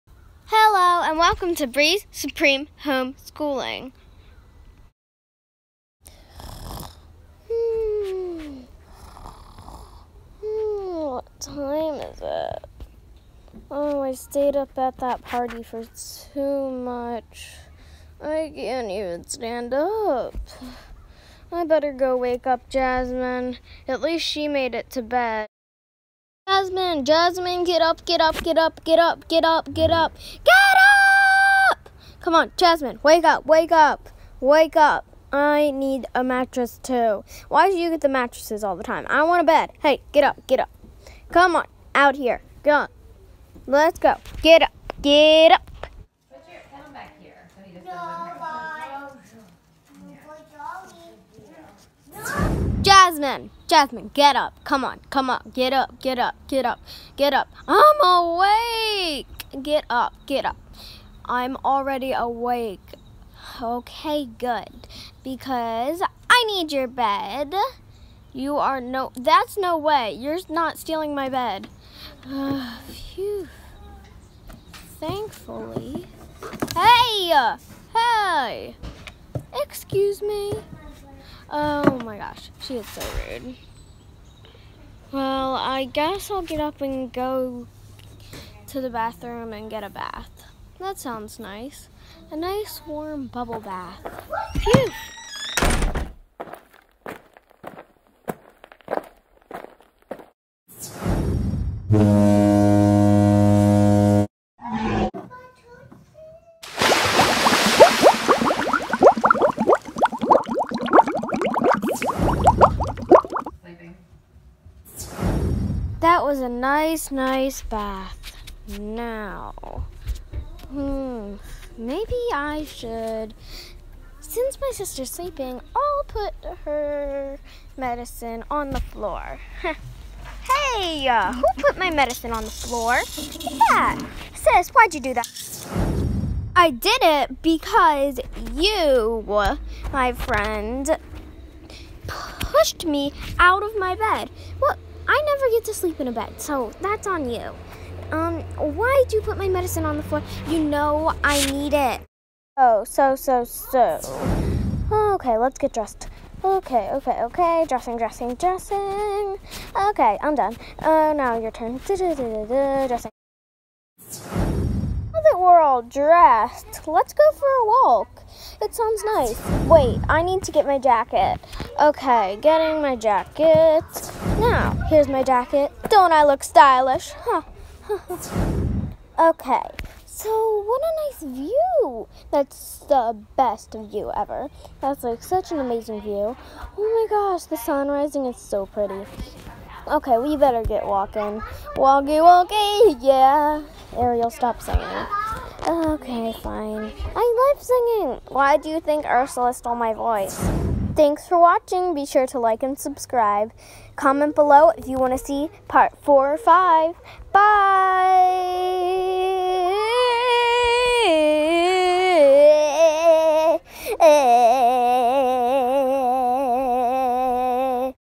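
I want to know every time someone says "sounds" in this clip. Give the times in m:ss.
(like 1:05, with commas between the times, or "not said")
1:30, 2:48.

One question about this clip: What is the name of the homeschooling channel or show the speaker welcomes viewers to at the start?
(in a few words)
Breeze Supreme Homeschooling.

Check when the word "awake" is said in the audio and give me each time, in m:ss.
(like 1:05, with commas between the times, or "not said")
0:58, 1:02.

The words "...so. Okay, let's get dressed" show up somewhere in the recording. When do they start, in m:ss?
2:33.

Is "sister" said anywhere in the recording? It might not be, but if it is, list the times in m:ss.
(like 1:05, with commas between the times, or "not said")
2:04.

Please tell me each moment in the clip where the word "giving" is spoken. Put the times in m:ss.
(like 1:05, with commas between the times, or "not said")
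not said.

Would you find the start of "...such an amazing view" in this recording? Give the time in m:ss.
3:05.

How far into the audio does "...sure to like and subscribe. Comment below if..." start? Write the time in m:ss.
3:22.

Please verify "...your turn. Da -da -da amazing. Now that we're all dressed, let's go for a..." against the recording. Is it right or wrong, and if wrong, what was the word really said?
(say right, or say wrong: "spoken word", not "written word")
wrong: "dressing", not "amazing".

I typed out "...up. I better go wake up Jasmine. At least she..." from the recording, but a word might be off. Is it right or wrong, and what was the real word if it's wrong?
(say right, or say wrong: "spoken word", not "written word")
right.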